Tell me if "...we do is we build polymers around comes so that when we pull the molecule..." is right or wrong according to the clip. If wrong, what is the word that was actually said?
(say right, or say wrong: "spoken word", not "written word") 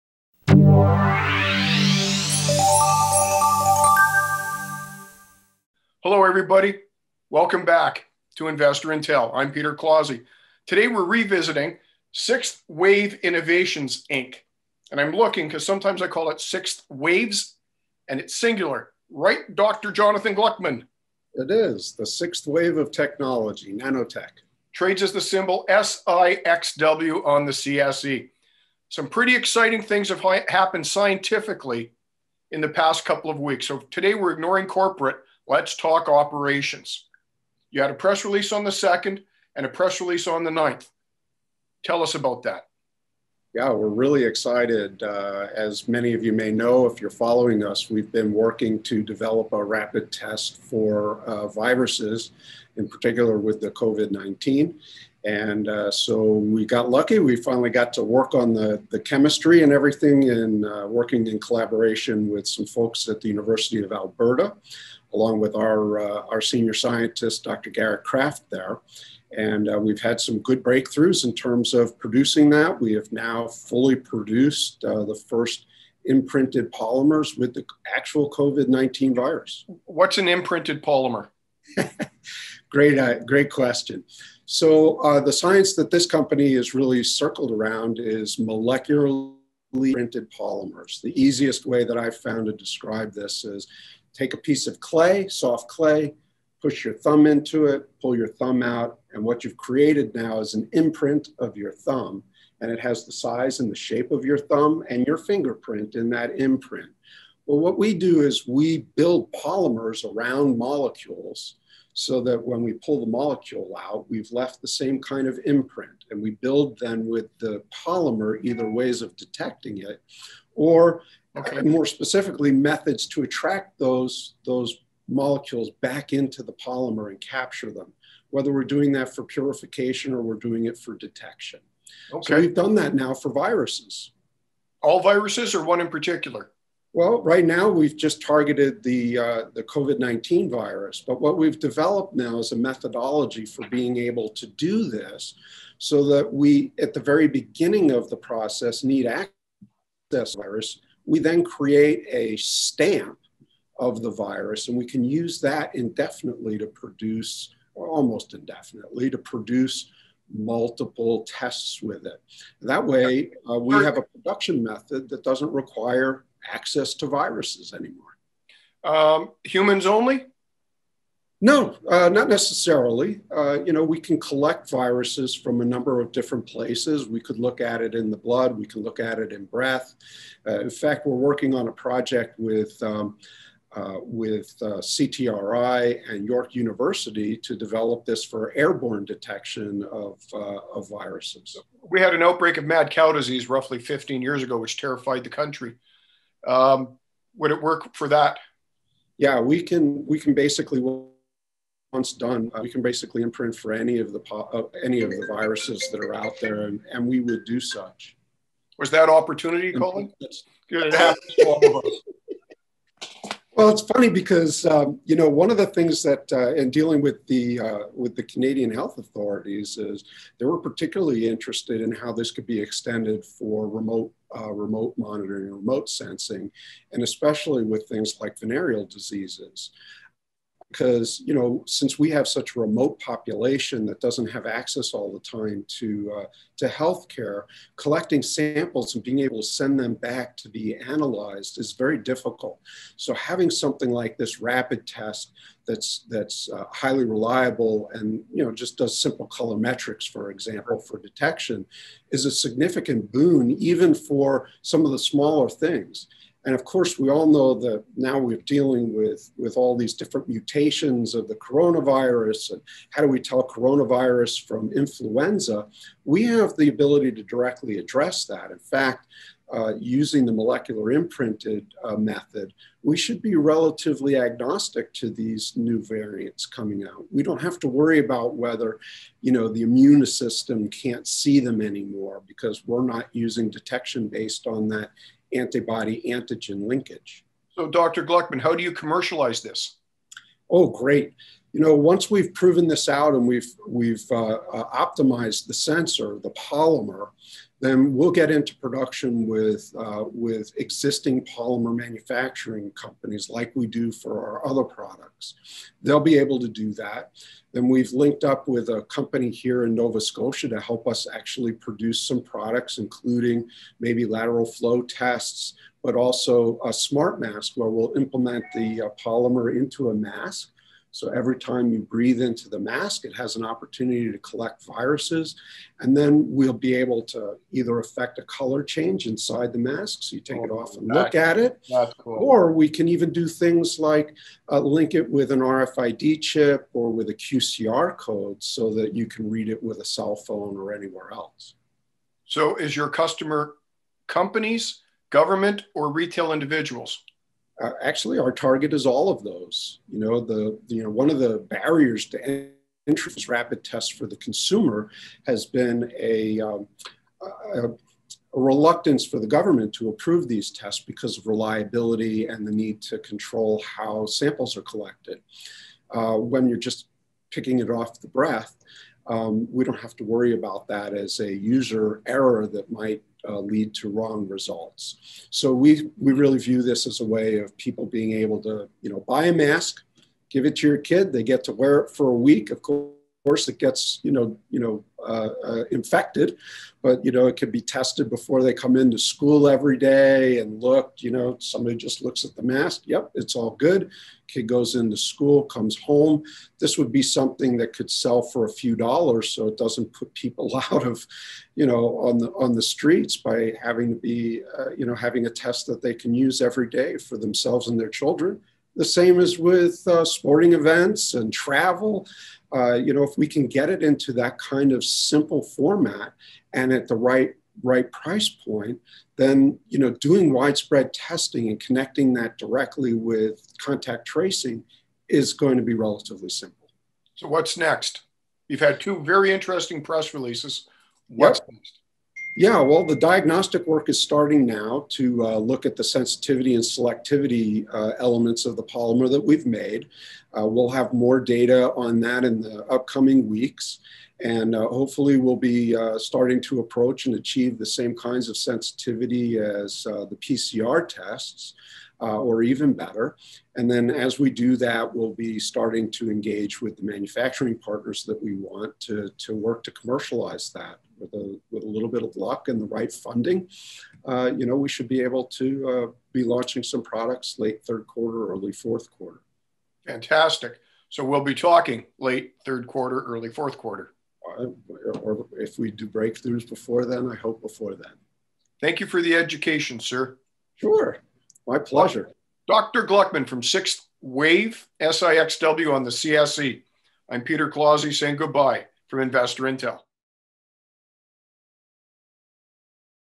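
wrong: "molecules", not "comes".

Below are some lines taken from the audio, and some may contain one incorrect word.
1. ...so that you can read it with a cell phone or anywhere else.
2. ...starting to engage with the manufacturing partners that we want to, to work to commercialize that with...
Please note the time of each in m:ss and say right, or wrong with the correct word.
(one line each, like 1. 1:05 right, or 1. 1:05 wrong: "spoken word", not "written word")
1. 5:38 right
2. 7:35 right.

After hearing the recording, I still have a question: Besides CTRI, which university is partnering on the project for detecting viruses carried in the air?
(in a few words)
York University.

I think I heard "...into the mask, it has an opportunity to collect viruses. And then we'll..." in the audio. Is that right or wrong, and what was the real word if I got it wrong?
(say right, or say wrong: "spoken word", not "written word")
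right.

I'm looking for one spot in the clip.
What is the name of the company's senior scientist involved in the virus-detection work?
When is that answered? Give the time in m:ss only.
1:07.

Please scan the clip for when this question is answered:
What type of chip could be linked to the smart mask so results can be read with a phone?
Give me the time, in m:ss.
5:35.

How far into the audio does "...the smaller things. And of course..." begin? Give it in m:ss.
4:14.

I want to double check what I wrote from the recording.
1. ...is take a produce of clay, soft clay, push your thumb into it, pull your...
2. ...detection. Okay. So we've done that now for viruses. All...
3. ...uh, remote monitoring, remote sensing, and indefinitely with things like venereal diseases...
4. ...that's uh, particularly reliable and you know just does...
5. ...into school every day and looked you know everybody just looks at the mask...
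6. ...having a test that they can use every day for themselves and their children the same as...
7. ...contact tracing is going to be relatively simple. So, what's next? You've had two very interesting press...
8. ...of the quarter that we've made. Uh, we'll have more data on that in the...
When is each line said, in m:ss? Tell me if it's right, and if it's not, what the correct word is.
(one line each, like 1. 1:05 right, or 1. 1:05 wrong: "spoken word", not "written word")
1. 1:33 wrong: "piece", not "produce"
2. 2:10 right
3. 3:44 wrong: "especially", not "indefinitely"
4. 4:06 wrong: "highly", not "particularly"
5. 6:28 wrong: "somebody", not "everybody"
6. 6:44 right
7. 7:03 right
8. 7:18 wrong: "polymer", not "quarter".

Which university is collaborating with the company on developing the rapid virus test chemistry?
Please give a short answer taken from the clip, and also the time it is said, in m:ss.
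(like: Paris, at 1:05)
University of Alberta, at 1:03.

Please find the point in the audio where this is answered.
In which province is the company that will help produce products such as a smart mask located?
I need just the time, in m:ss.
5:09.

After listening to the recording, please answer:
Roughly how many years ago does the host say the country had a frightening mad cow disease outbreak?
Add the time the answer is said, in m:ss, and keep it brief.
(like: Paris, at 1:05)
15, at 3:13.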